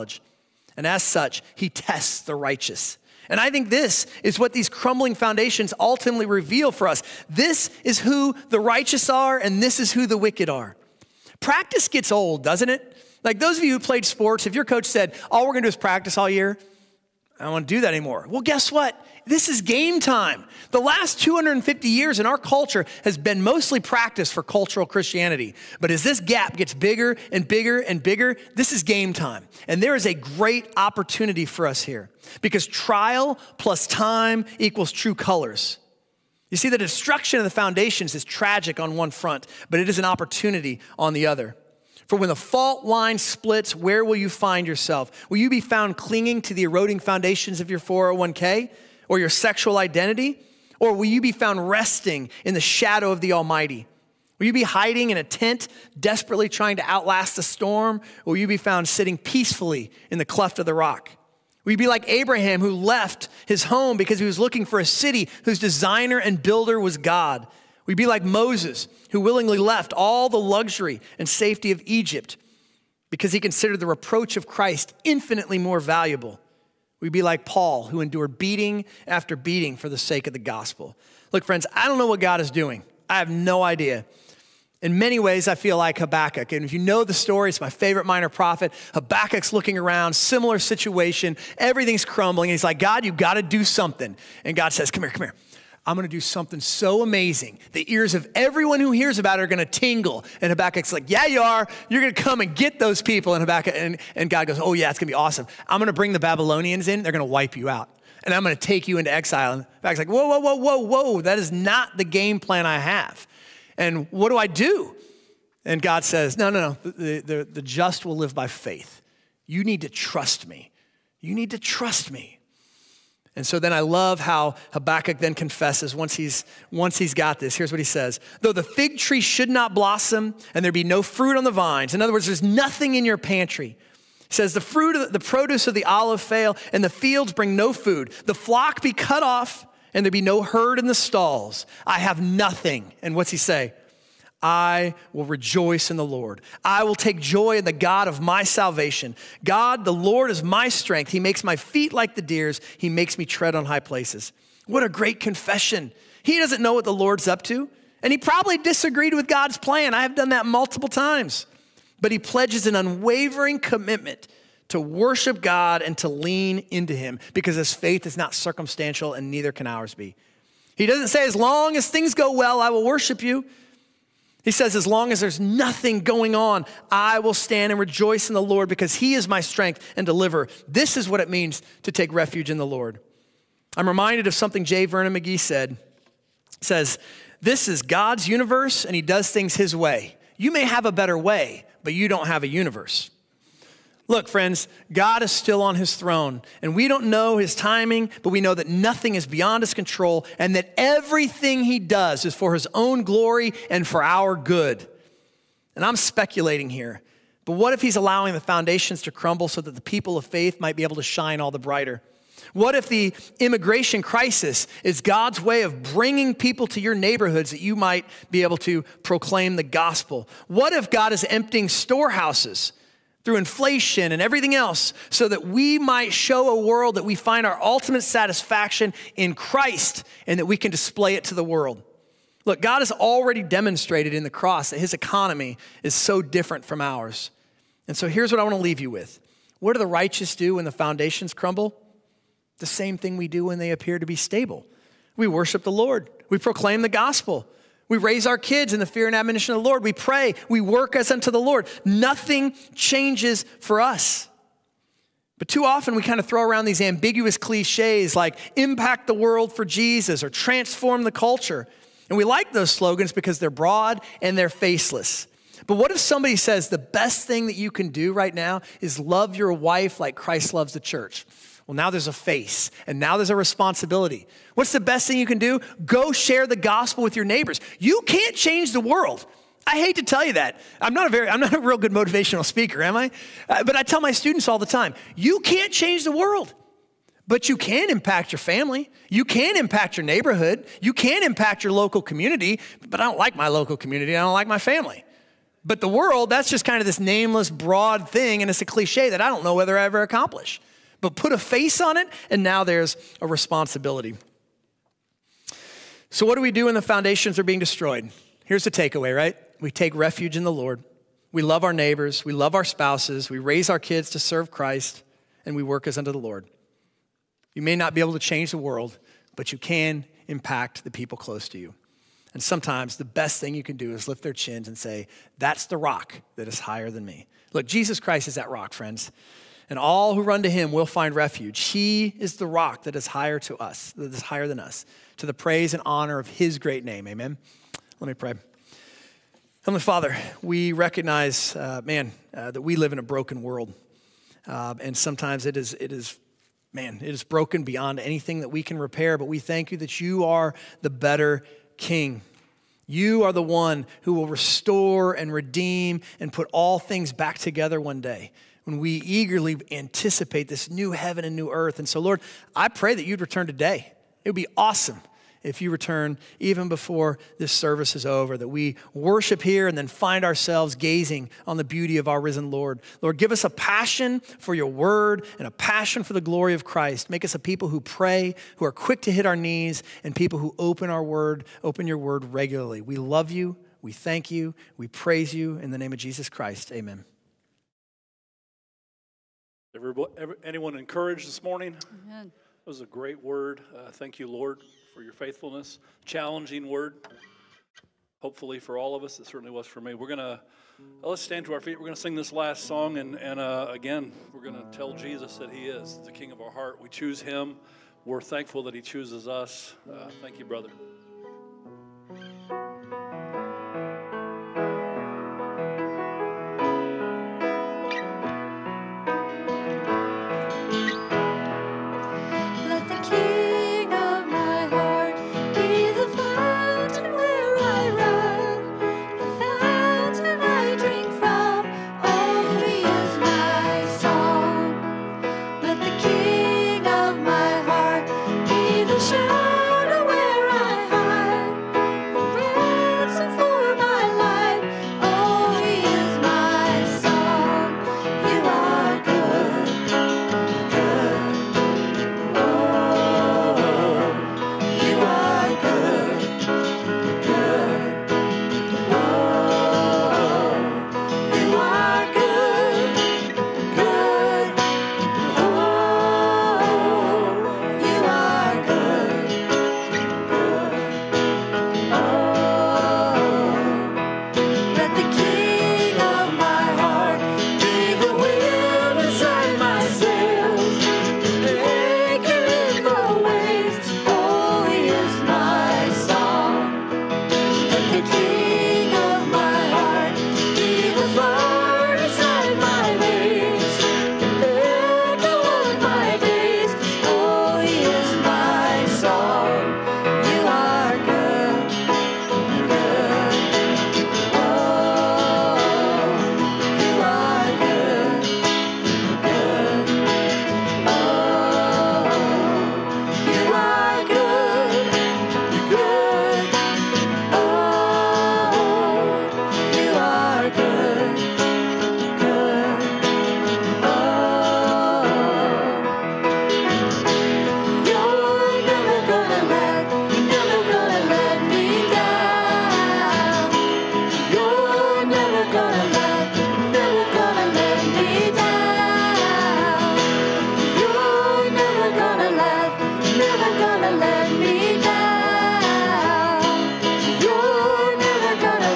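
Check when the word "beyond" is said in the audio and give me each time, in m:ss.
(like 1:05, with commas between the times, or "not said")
3:19, 5:47.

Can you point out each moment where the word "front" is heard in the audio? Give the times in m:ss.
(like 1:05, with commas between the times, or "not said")
0:39.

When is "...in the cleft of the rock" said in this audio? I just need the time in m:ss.
1:00.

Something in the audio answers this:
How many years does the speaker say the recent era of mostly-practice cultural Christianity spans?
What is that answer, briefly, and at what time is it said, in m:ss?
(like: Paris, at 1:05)
250, at 0:21.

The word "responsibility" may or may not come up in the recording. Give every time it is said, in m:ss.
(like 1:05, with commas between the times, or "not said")
4:33, 5:03.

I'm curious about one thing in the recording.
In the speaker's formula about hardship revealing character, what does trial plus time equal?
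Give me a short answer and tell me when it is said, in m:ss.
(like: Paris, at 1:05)
true colors, at 0:34.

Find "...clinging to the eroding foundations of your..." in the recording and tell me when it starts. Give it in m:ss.
0:45.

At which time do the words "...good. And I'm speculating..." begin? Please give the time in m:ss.
3:24.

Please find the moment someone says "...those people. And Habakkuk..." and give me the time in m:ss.
1:42.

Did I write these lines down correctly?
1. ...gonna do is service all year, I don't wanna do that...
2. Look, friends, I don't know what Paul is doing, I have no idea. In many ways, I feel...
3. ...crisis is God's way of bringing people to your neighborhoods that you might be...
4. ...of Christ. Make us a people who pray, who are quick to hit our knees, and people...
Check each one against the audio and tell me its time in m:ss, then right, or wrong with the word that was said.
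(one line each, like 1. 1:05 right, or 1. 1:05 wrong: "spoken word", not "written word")
1. 0:15 wrong: "practice", not "service"
2. 1:21 wrong: "God", not "Paul"
3. 3:34 right
4. 6:16 right.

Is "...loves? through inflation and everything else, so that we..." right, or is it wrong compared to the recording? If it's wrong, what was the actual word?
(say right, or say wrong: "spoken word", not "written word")
wrong: "storehouses", not "loves".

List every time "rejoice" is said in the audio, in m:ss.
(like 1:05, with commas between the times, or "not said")
2:25, 2:57.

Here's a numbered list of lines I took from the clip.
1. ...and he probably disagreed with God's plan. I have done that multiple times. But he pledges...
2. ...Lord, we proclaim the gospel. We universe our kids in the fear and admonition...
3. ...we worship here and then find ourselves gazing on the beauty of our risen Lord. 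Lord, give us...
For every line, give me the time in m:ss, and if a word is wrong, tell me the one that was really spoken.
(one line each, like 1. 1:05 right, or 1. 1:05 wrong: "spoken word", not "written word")
1. 2:38 right
2. 4:05 wrong: "raise", not "universe"
3. 6:08 right.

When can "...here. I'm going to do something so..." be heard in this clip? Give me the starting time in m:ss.
1:35.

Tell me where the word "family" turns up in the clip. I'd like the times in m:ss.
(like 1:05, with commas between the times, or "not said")
4:48, 4:54.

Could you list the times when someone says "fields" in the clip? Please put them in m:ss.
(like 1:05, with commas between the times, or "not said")
2:16.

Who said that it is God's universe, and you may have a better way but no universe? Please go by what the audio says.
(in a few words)
J. Vernon McGee.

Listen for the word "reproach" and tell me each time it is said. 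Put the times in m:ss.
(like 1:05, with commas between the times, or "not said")
1:13.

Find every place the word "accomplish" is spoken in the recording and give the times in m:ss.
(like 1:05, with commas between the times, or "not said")
5:00.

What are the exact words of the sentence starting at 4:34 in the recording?
What's the best thing you can do?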